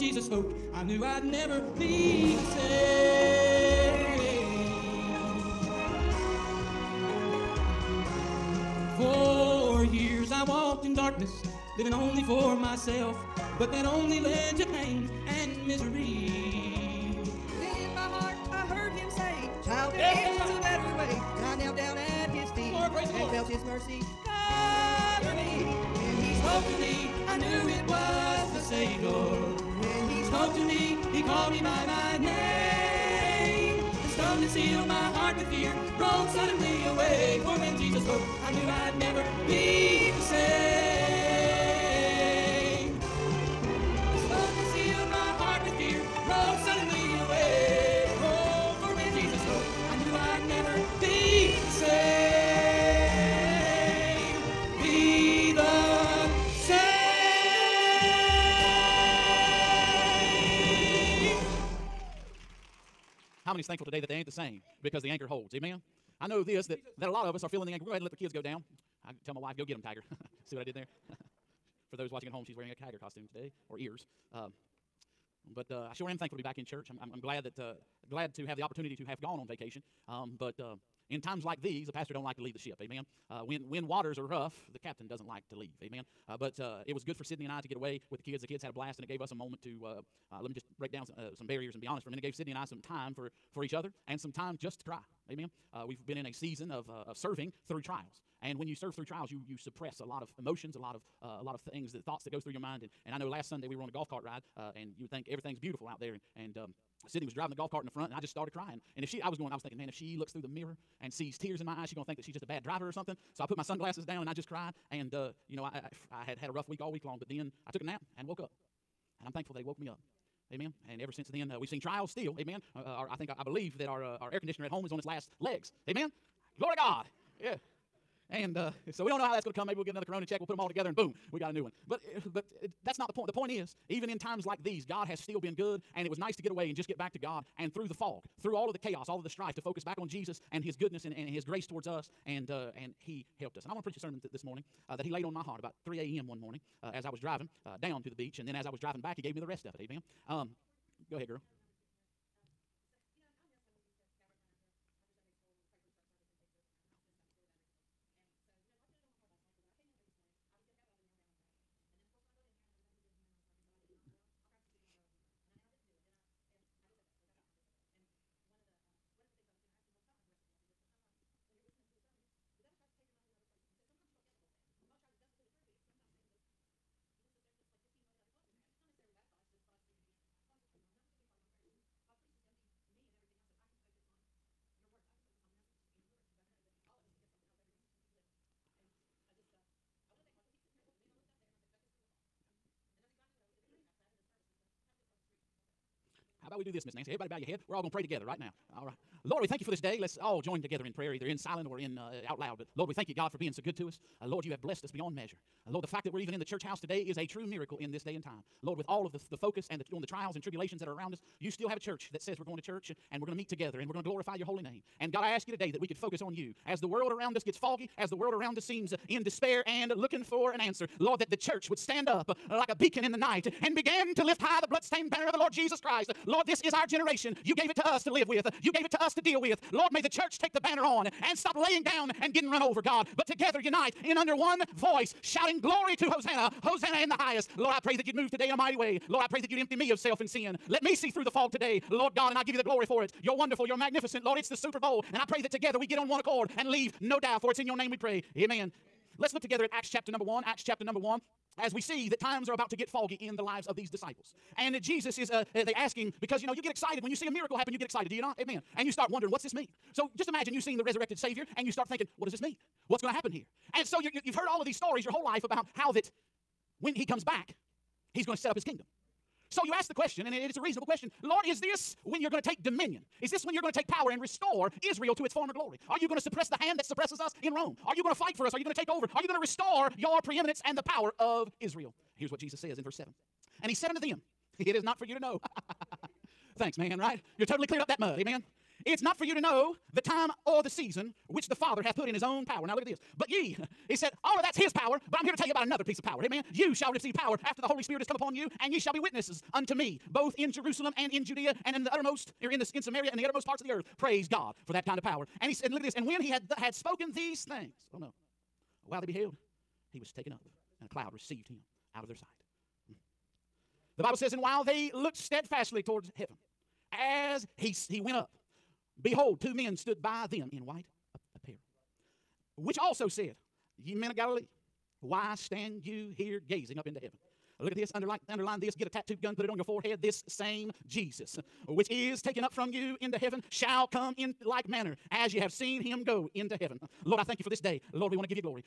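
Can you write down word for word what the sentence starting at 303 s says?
Praise God for that kind of power.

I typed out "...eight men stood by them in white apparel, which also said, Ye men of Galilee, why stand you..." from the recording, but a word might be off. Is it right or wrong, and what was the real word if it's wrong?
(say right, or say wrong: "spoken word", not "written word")
wrong: "two", not "eight".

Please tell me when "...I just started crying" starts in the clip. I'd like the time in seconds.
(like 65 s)
108 s.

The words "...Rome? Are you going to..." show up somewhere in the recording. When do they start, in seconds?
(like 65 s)
277 s.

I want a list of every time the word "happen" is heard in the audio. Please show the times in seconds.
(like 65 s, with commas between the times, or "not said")
257 s, 263 s.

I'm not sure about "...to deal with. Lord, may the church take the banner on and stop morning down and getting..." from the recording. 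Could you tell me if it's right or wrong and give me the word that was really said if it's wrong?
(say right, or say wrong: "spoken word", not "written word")
wrong: "laying", not "morning".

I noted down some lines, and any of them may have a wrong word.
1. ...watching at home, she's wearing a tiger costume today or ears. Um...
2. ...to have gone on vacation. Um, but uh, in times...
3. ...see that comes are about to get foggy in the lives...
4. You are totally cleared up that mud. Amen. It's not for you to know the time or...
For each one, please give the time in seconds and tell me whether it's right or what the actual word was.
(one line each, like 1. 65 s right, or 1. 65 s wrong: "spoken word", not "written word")
1. 72 s right
2. 78 s right
3. 251 s wrong: "times", not "comes"
4. 287 s right.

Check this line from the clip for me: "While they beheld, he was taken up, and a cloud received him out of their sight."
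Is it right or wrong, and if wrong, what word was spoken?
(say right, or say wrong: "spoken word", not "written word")
right.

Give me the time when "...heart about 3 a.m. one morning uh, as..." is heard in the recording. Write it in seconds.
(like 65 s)
145 s.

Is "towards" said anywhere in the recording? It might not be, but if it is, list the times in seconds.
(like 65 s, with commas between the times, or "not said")
141 s, 315 s.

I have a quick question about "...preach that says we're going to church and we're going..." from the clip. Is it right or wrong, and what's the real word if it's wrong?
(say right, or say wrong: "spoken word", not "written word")
wrong: "church", not "preach".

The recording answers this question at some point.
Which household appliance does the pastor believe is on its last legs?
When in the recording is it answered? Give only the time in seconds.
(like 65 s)
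124 s.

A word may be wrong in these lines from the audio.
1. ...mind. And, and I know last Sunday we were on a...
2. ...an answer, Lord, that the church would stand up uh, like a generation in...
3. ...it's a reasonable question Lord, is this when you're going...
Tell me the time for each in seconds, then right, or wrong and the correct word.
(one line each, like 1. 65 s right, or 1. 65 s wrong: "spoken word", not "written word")
1. 102 s right
2. 220 s wrong: "beacon", not "generation"
3. 270 s right.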